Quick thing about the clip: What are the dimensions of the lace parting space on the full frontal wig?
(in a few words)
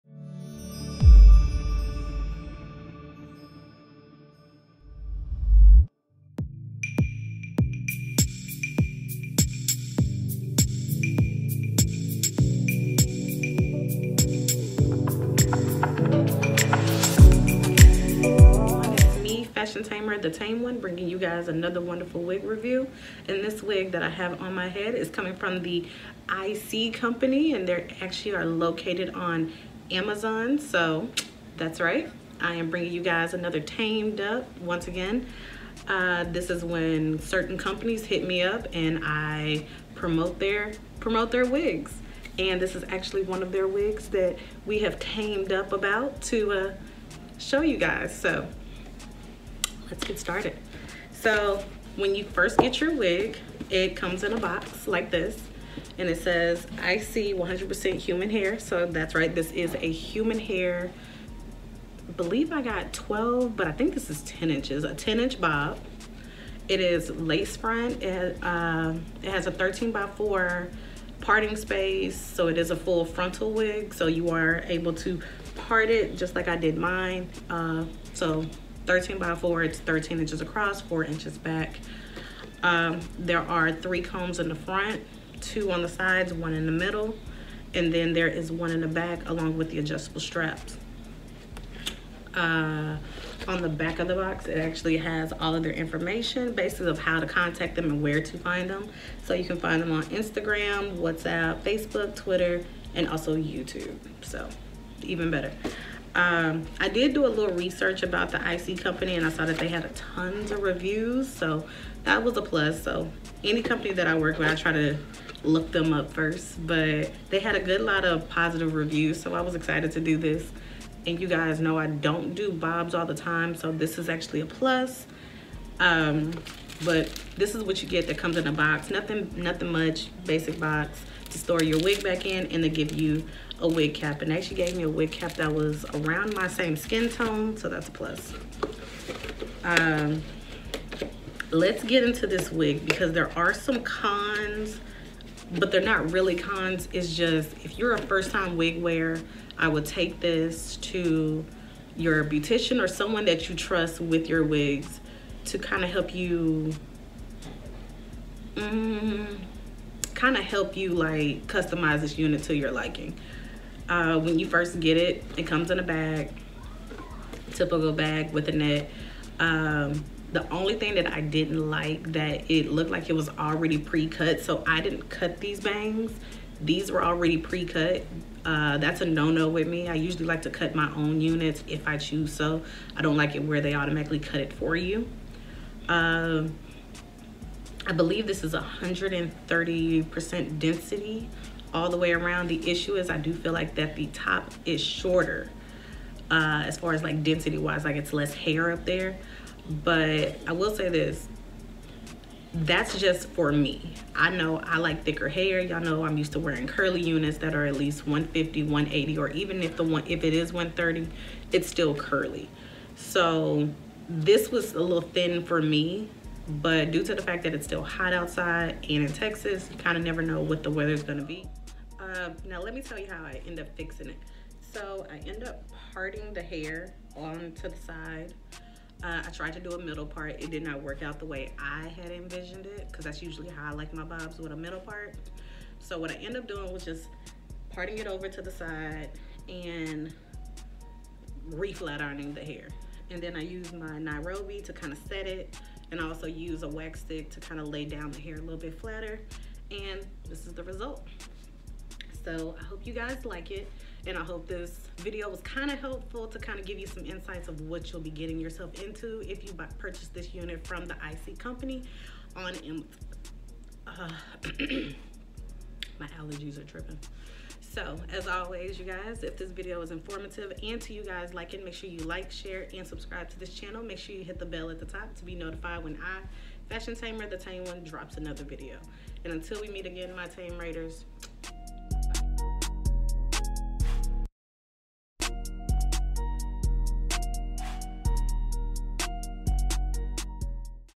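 13 by 4.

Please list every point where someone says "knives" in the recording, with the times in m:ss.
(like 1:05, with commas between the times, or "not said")
not said.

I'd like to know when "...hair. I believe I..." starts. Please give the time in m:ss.
1:00.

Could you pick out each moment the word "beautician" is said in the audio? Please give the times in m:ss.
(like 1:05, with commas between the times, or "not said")
2:32.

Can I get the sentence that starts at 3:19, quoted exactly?
But I will say this, that's just for me.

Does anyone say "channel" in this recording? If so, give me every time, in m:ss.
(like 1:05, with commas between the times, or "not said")
4:33.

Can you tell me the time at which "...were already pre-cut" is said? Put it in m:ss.
2:56.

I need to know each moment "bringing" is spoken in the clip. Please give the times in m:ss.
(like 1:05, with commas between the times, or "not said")
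0:20, 0:32.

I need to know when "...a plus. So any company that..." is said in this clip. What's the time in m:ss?
1:52.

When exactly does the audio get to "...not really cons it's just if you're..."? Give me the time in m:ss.
2:25.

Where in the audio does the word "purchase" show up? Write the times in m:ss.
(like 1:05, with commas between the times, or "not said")
4:19.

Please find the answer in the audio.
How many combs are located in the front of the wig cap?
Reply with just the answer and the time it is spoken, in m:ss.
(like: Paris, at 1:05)
3, at 1:23.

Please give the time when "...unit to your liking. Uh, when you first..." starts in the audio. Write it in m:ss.
2:42.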